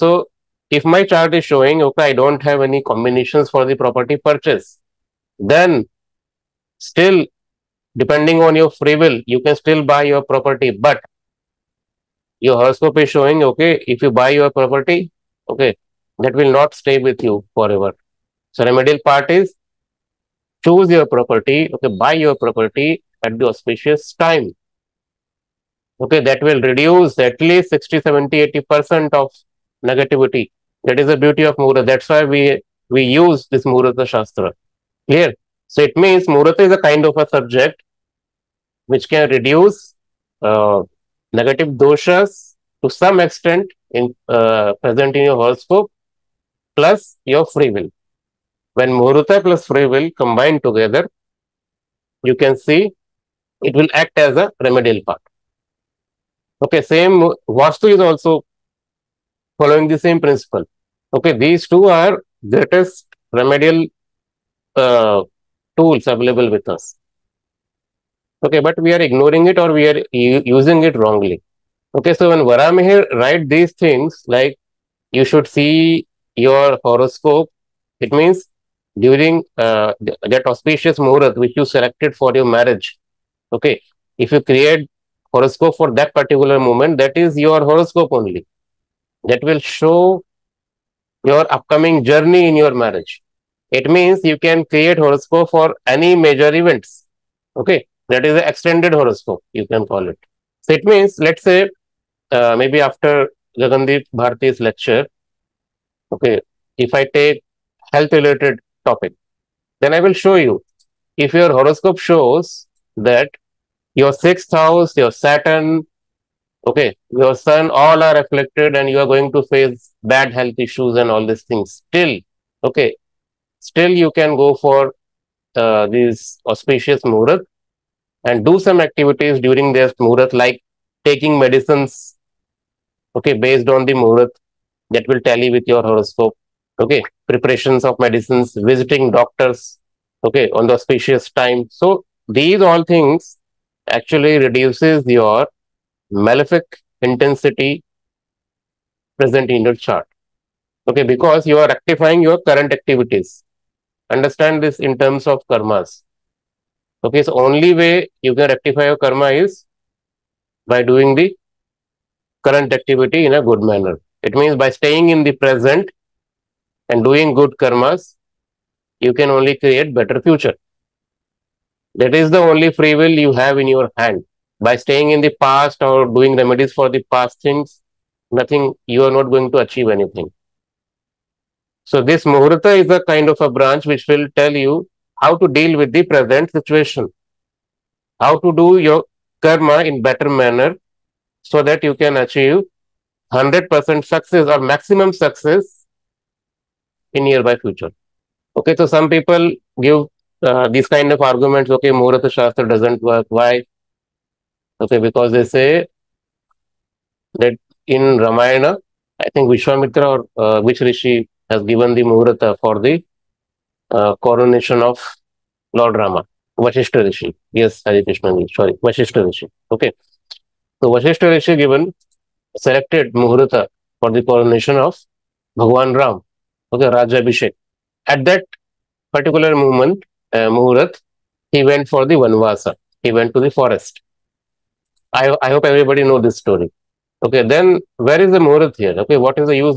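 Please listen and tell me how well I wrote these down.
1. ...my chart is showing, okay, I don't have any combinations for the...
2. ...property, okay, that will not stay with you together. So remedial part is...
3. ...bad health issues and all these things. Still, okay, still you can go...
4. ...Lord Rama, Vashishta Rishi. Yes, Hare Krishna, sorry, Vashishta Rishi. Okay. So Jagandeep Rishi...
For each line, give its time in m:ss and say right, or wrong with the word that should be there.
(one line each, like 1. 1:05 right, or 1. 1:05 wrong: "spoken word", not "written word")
1. 0:00 right
2. 0:14 wrong: "forever", not "together"
3. 2:00 right
4. 3:35 wrong: "Vashishta", not "Jagandeep".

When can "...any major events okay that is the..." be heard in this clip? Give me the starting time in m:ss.
1:35.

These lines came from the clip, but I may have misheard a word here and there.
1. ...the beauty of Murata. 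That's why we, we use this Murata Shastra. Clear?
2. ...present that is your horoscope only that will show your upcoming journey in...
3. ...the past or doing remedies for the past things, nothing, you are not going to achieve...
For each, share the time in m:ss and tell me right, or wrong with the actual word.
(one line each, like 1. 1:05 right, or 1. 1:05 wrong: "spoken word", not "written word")
1. 0:31 right
2. 1:26 wrong: "moment", not "present"
3. 2:55 right.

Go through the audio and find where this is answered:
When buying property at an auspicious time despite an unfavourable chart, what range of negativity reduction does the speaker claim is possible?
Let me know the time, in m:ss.
0:27.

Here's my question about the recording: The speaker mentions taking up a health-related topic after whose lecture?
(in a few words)
Jagandeep Bharti.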